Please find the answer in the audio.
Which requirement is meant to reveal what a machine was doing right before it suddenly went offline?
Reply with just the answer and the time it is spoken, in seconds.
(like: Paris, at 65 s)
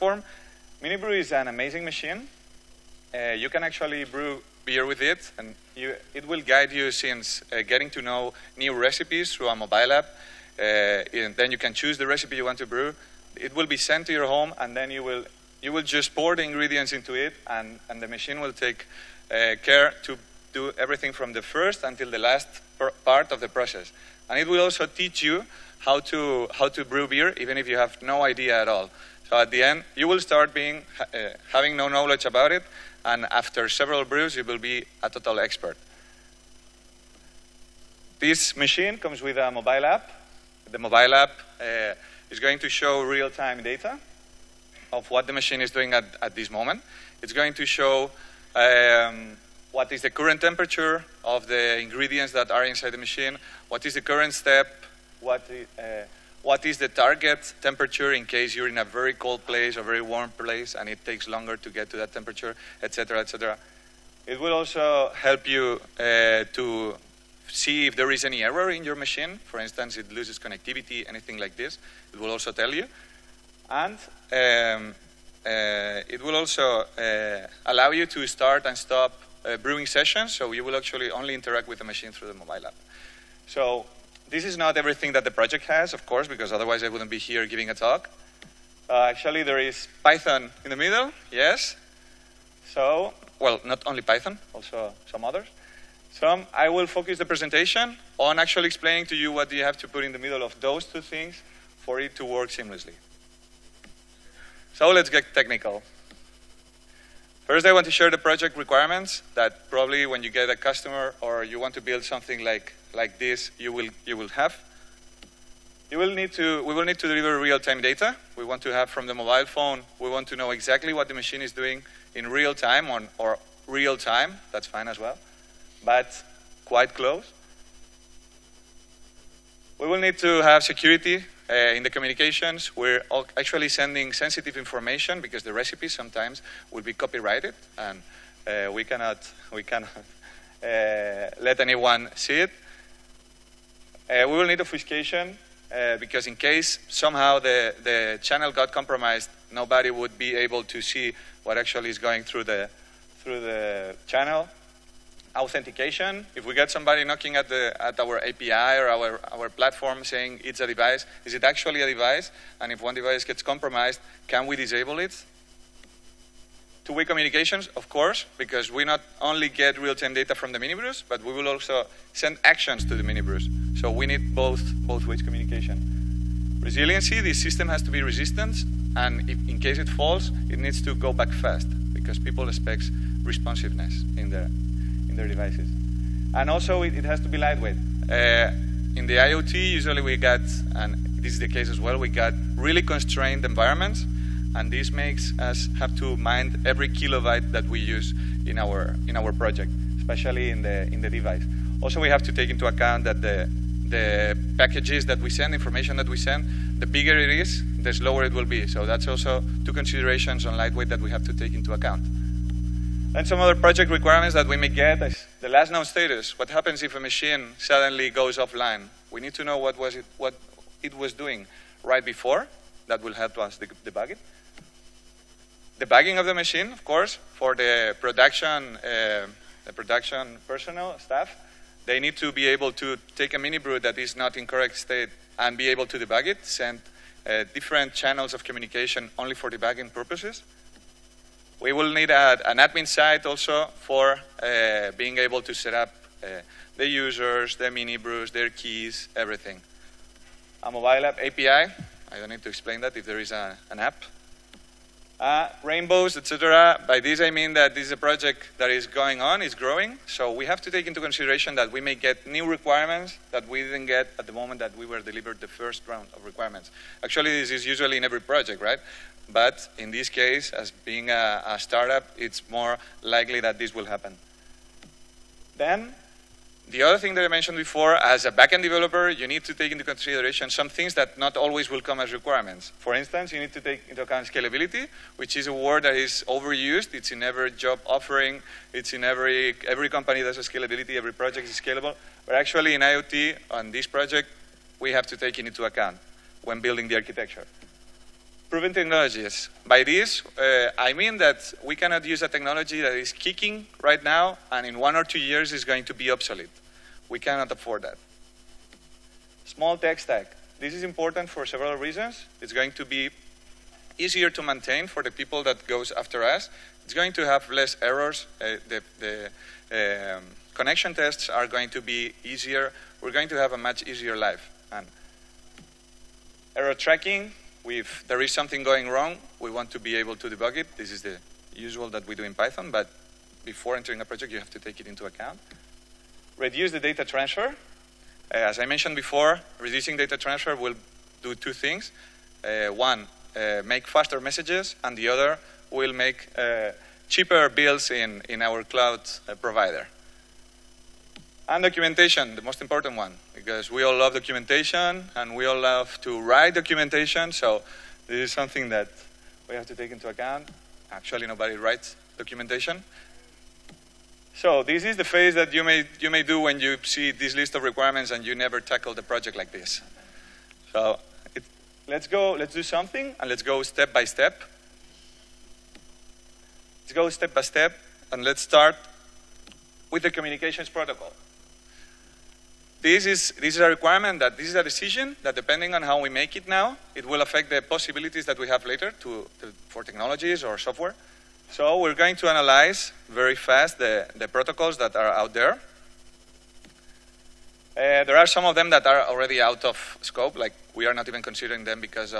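Last known status, at 215 s.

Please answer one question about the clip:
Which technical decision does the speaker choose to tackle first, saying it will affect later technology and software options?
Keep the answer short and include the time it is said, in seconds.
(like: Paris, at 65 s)
Communications protocol, at 380 s.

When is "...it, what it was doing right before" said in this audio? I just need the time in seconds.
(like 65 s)
219 s.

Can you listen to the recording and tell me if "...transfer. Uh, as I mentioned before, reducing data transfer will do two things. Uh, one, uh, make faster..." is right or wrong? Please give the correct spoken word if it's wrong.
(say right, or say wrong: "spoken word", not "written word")
right.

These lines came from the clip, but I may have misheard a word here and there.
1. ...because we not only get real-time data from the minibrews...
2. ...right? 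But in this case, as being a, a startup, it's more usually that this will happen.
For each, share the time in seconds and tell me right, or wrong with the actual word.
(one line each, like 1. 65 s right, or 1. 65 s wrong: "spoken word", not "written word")
1. 168 s right
2. 268 s wrong: "likely", not "usually".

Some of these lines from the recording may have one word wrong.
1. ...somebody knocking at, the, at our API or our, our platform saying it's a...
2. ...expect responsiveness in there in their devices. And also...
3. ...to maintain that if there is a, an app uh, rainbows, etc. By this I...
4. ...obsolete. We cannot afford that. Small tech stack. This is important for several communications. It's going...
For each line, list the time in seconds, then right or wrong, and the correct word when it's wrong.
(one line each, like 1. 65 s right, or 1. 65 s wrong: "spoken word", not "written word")
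1. 156 s right
2. 182 s right
3. 252 s wrong: "explain", not "maintain"
4. 306 s wrong: "reasons", not "communications".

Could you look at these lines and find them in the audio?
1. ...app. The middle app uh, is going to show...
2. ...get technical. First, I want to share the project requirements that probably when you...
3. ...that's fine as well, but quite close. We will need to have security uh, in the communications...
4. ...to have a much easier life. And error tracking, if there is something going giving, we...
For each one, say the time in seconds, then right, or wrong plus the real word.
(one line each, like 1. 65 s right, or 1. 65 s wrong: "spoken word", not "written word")
1. 39 s wrong: "mobile", not "middle"
2. 105 s right
3. 124 s right
4. 323 s wrong: "wrong", not "giving".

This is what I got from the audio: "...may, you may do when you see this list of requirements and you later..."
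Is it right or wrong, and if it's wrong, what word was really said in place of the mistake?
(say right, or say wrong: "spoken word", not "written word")
wrong: "never", not "later".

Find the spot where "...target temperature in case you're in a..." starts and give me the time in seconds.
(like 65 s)
56 s.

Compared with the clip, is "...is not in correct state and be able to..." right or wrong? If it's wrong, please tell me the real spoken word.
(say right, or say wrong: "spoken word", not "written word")
right.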